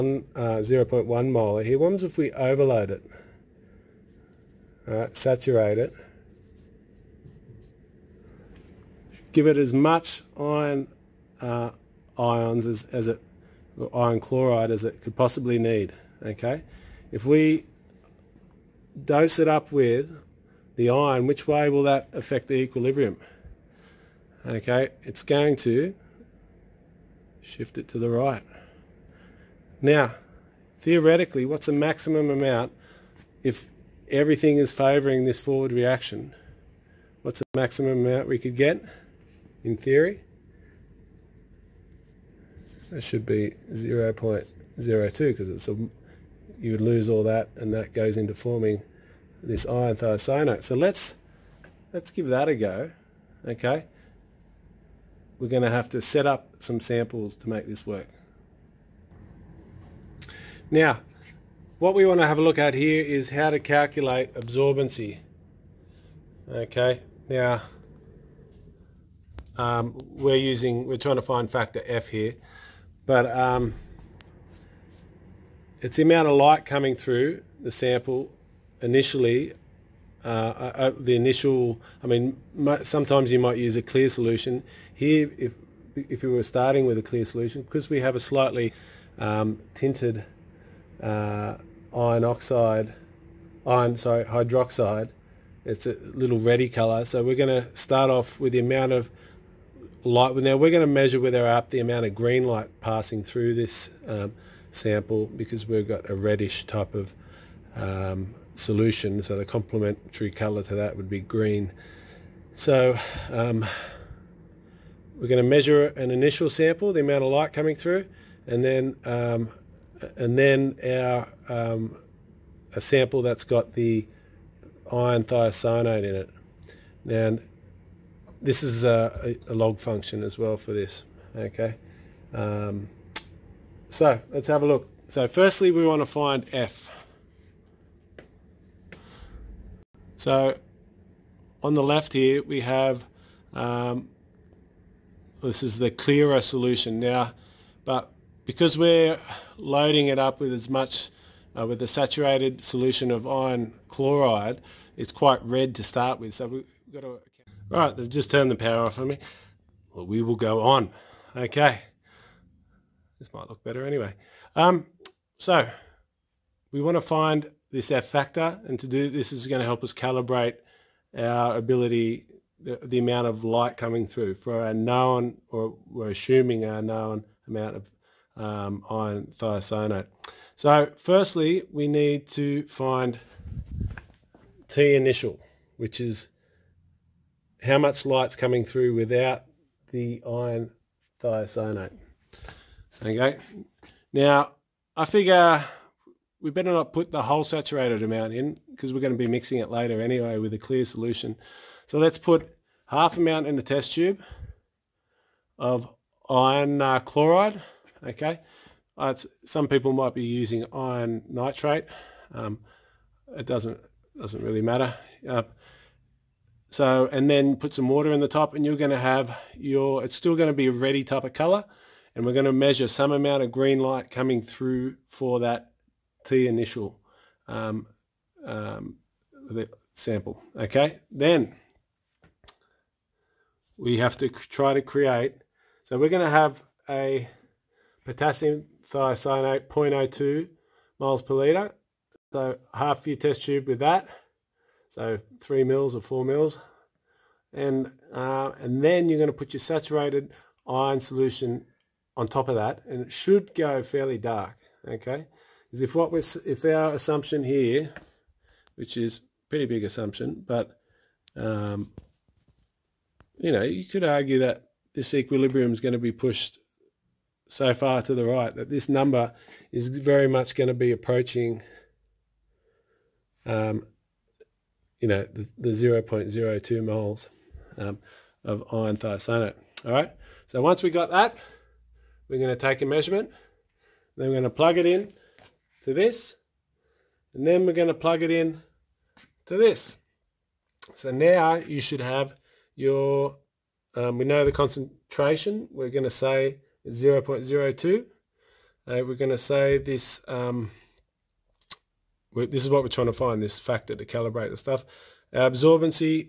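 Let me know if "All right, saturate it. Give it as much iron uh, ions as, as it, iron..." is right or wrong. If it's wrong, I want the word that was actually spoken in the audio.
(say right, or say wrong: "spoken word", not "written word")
right.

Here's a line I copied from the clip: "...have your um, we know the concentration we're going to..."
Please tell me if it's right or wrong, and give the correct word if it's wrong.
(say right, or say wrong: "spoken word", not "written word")
right.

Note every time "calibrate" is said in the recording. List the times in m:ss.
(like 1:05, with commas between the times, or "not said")
2:49, 5:04.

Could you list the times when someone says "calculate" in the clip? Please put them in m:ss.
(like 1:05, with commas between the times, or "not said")
1:03.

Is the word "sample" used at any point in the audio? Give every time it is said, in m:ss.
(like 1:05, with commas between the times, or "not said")
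0:56, 1:17, 1:44, 1:56, 2:02, 3:49.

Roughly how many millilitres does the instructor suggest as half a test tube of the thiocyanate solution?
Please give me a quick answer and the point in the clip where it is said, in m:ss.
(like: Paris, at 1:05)
3 or 4, at 4:05.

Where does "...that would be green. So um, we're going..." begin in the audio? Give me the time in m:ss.
1:50.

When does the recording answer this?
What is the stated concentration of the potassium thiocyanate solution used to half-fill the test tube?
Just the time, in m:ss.
3:59.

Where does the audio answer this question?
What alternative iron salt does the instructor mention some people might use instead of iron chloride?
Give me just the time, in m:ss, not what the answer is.
3:30.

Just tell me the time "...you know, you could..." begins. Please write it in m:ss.
4:23.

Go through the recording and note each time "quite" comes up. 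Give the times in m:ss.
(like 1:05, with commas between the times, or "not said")
2:35.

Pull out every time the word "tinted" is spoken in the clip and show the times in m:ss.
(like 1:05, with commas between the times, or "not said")
1:29.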